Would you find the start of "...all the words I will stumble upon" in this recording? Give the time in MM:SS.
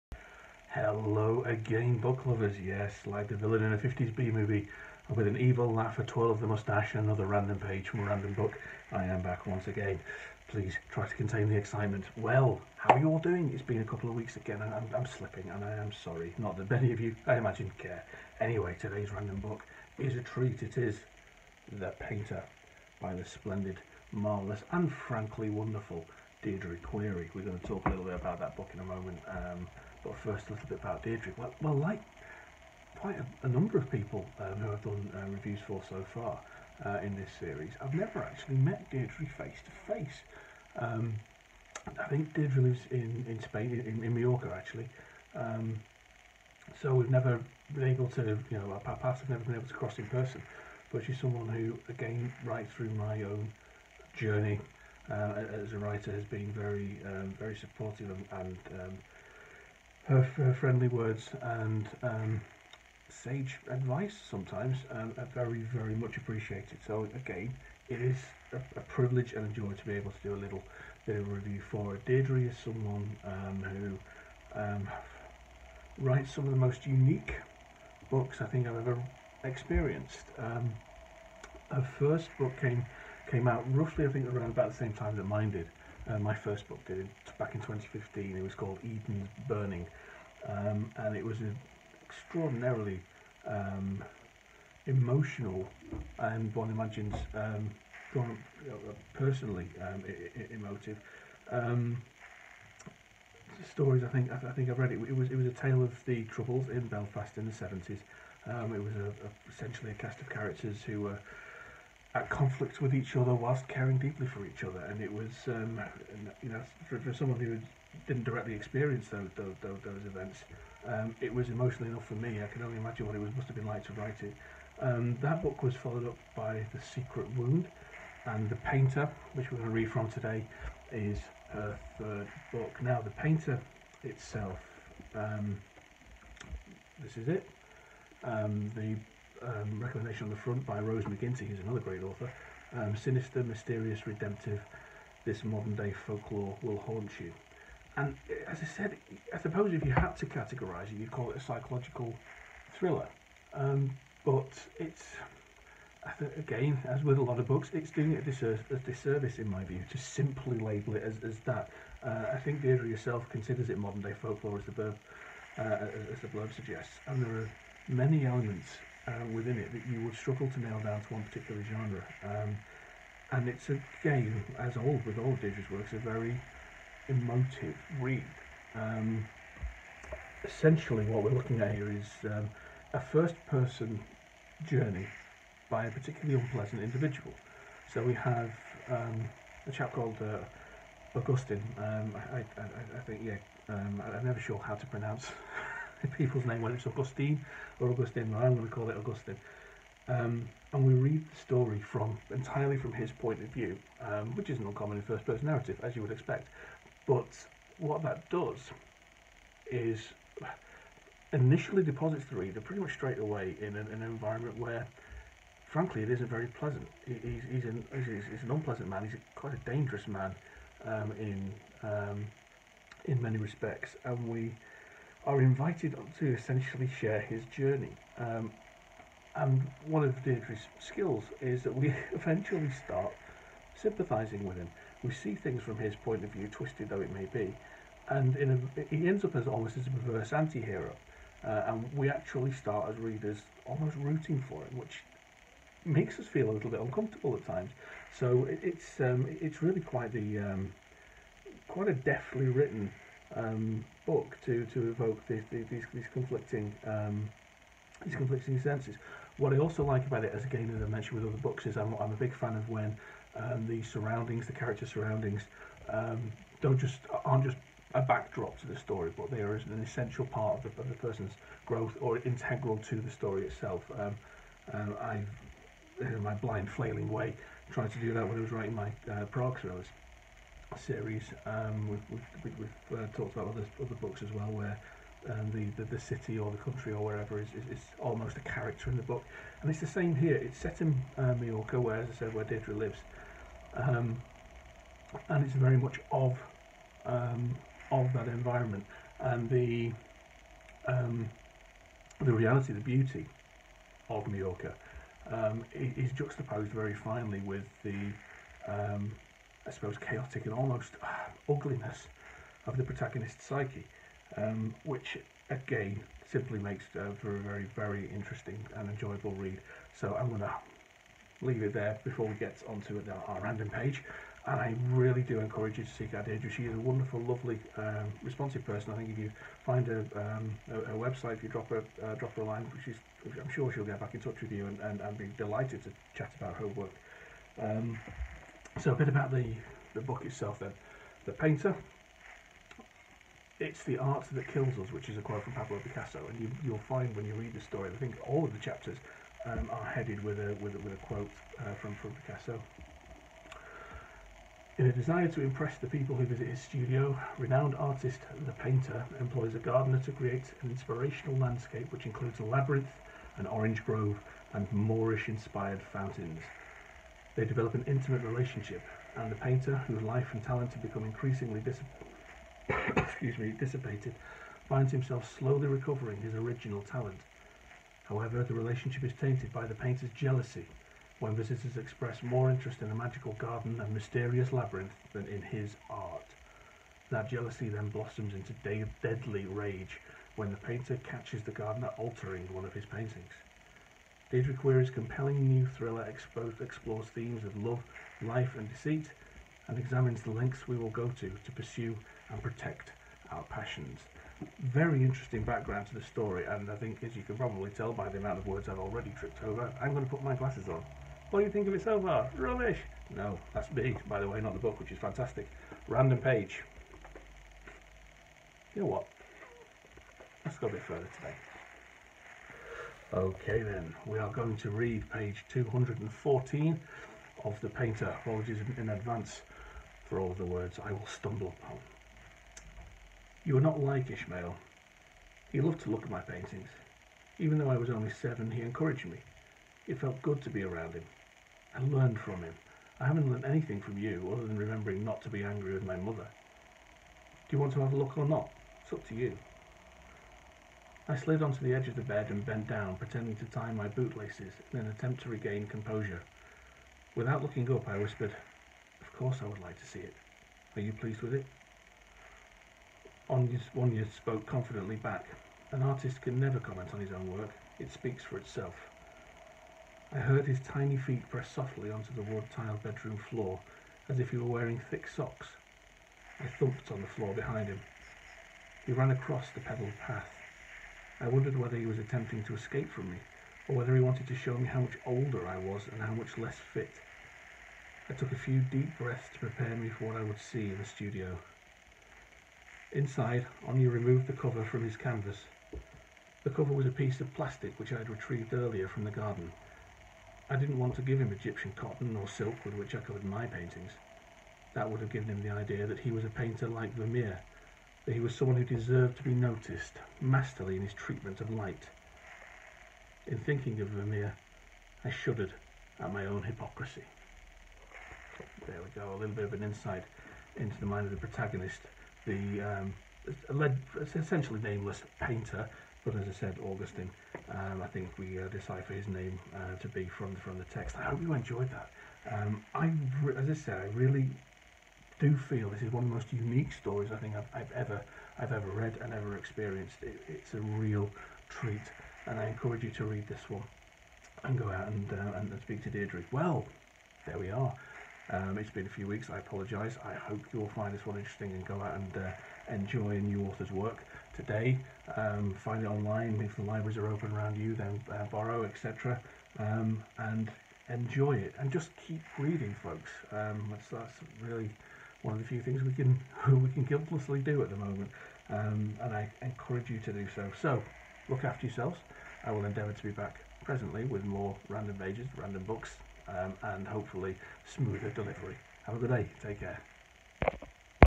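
07:10.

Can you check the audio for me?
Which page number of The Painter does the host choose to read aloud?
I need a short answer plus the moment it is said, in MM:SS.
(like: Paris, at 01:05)
214, at 07:05.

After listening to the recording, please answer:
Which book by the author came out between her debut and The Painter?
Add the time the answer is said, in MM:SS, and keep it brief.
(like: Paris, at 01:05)
The Secret Wound, at 02:06.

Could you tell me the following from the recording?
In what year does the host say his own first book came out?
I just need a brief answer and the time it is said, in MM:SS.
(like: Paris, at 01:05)
2015, at 01:27.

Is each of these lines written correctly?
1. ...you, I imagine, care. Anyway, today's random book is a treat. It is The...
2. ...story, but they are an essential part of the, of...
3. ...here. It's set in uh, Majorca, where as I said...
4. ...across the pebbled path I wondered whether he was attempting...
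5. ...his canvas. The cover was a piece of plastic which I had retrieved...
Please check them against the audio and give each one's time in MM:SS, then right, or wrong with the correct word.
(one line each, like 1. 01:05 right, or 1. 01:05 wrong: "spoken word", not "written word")
1. 00:17 right
2. 04:28 right
3. 04:50 right
4. 07:59 right
5. 08:14 right.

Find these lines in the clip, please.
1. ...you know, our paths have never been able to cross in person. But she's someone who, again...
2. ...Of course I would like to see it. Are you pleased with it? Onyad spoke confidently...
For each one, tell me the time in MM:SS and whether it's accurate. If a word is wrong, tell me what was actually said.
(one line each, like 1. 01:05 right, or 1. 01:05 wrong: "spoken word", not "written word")
1. 00:48 right
2. 07:39 right.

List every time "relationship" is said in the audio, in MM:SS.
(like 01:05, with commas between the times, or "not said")
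06:08, 06:18.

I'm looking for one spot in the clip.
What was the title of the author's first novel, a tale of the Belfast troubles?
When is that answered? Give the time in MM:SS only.
01:28.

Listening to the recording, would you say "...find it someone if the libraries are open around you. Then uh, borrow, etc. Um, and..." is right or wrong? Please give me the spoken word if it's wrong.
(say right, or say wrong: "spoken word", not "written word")
wrong: "online", not "someone".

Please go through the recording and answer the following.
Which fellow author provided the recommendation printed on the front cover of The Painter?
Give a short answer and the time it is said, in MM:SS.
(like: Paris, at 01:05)
Rose McGinty, at 02:20.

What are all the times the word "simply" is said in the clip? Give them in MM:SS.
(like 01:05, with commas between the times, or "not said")
02:39, 05:16.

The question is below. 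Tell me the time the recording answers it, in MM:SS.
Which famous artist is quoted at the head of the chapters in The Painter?
05:45.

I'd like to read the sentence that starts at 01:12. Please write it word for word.
Deirdre is someone um, who um, writes some of the most unique books I think I've ever experienced.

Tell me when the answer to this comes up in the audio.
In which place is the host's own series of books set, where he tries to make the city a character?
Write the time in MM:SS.
04:39.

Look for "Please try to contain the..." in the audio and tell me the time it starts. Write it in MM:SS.
00:10.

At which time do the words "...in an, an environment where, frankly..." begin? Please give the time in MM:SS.
03:33.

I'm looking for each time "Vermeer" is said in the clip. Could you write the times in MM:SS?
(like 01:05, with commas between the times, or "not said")
08:26, 08:33.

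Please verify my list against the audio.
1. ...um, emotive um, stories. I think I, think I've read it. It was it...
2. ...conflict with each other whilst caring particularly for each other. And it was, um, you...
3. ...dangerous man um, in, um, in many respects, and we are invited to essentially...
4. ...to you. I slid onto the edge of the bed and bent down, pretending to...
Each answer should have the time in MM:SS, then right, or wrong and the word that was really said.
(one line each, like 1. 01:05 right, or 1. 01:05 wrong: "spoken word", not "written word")
1. 01:39 right
2. 01:52 wrong: "deeply", not "particularly"
3. 03:39 right
4. 07:29 right.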